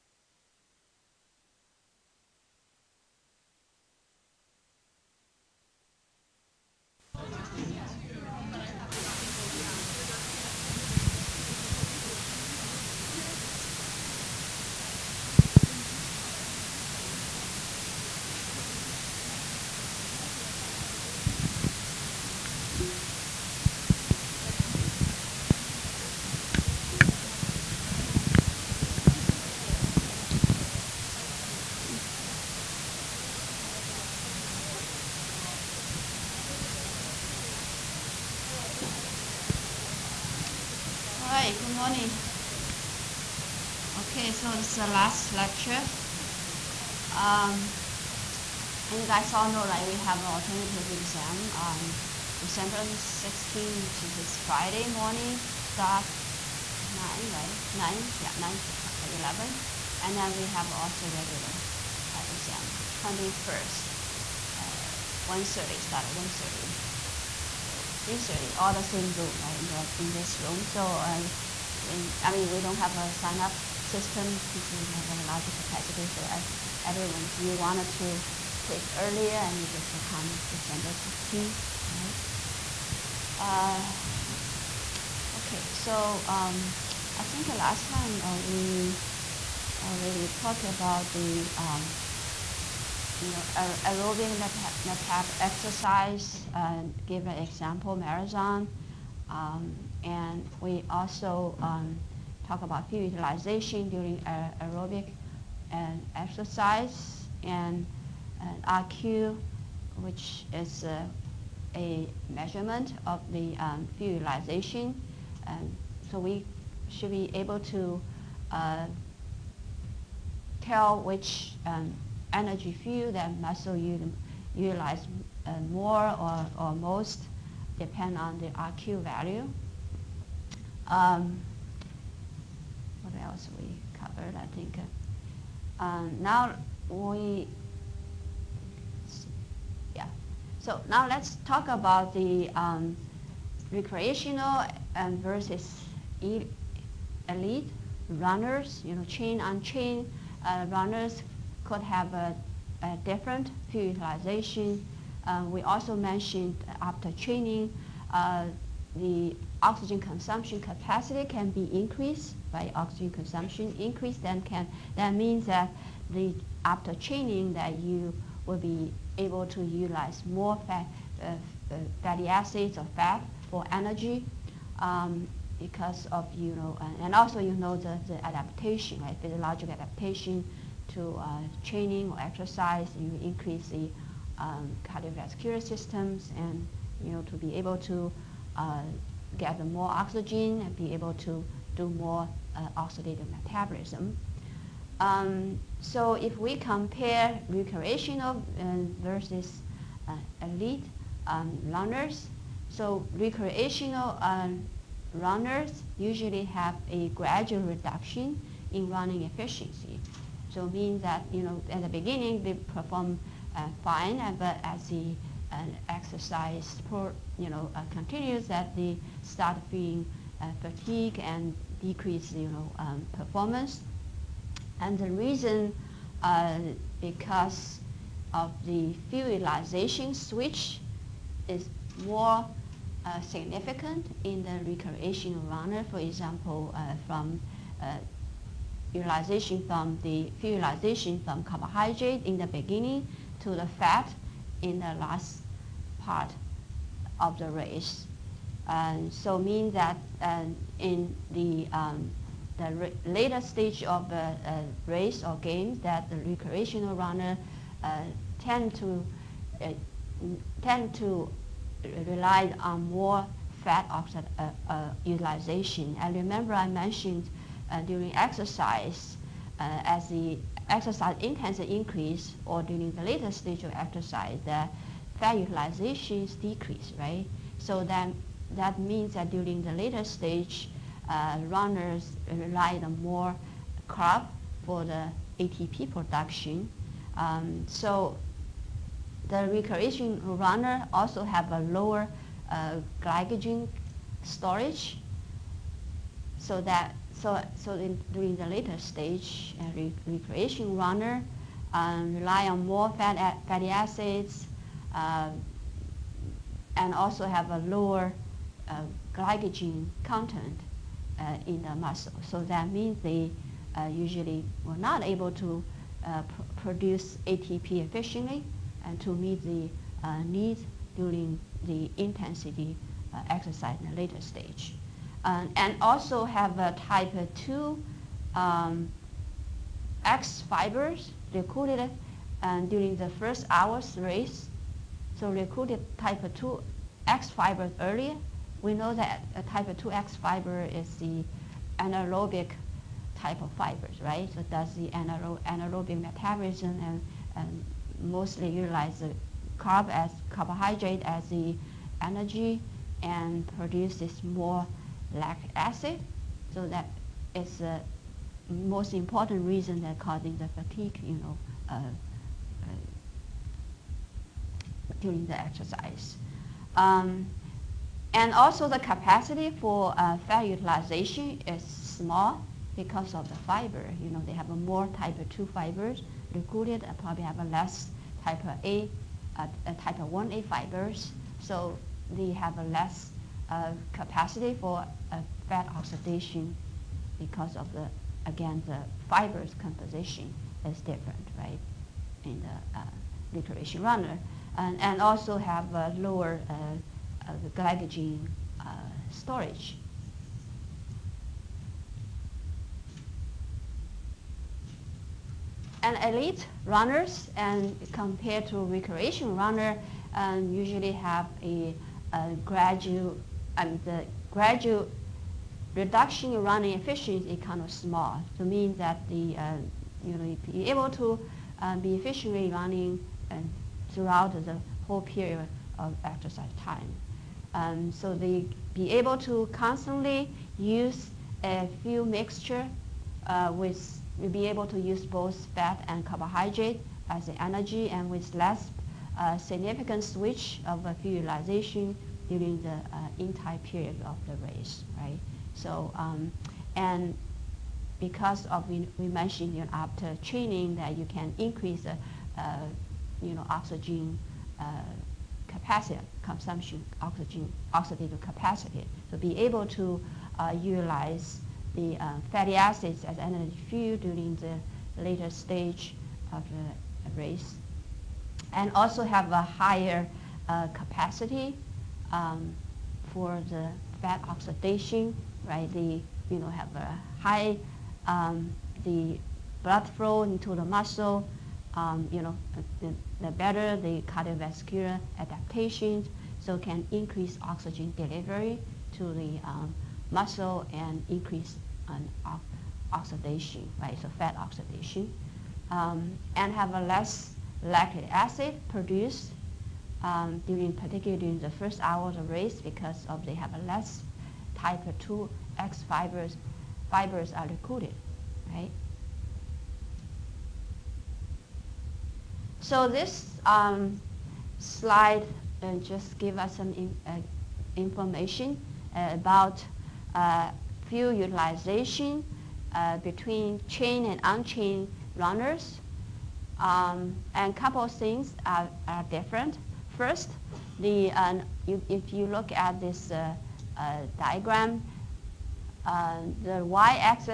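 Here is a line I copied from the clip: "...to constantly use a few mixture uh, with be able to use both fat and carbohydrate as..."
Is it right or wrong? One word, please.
right.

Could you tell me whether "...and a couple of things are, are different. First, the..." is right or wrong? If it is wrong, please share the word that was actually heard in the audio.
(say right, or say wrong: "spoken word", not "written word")
right.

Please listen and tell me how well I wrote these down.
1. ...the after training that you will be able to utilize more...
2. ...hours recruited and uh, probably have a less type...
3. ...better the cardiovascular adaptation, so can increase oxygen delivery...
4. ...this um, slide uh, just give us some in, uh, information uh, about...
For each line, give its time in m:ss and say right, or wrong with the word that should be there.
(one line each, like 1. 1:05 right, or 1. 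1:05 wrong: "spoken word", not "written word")
1. 2:46 right
2. 6:15 wrong: "fibers", not "hours"
3. 8:03 right
4. 8:32 right.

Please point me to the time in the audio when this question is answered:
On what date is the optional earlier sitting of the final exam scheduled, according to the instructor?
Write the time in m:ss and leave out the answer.
0:52.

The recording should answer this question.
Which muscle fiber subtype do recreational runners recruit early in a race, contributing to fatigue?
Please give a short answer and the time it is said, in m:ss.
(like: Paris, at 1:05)
Type 2 X fibers, at 5:26.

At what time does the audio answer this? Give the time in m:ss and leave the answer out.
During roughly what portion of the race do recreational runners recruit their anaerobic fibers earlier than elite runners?
5:33.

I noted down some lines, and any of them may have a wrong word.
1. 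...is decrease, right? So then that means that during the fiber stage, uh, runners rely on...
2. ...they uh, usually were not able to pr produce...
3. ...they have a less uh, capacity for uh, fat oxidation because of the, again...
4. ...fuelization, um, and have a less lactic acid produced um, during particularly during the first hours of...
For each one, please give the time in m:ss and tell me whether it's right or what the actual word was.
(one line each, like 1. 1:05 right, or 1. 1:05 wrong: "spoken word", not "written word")
1. 4:36 wrong: "later", not "fiber"
2. 5:13 right
3. 6:22 right
4. 8:14 wrong: "oxidation", not "fuelization".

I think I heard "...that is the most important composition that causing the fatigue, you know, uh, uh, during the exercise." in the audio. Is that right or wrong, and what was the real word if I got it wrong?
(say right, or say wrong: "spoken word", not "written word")
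wrong: "reason", not "composition".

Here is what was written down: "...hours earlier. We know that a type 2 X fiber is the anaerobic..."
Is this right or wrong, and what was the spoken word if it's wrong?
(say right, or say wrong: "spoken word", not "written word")
wrong: "fibers", not "hours".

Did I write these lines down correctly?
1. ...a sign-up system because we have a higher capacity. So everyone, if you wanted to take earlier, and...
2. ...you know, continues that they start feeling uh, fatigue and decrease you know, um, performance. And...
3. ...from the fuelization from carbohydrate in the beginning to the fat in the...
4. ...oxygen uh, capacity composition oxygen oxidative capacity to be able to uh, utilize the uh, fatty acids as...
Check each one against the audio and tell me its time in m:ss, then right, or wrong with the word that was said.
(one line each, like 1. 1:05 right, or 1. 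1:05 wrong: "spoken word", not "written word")
1. 1:12 wrong: "larger", not "higher"
2. 3:37 right
3. 3:59 right
4. 7:33 wrong: "consumption", not "composition".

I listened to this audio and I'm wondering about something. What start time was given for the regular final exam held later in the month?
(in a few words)
1:30.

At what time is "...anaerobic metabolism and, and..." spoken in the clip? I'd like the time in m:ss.
5:45.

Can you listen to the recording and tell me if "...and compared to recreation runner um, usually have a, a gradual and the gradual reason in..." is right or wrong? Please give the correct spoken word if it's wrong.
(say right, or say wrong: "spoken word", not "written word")
wrong: "reduction", not "reason".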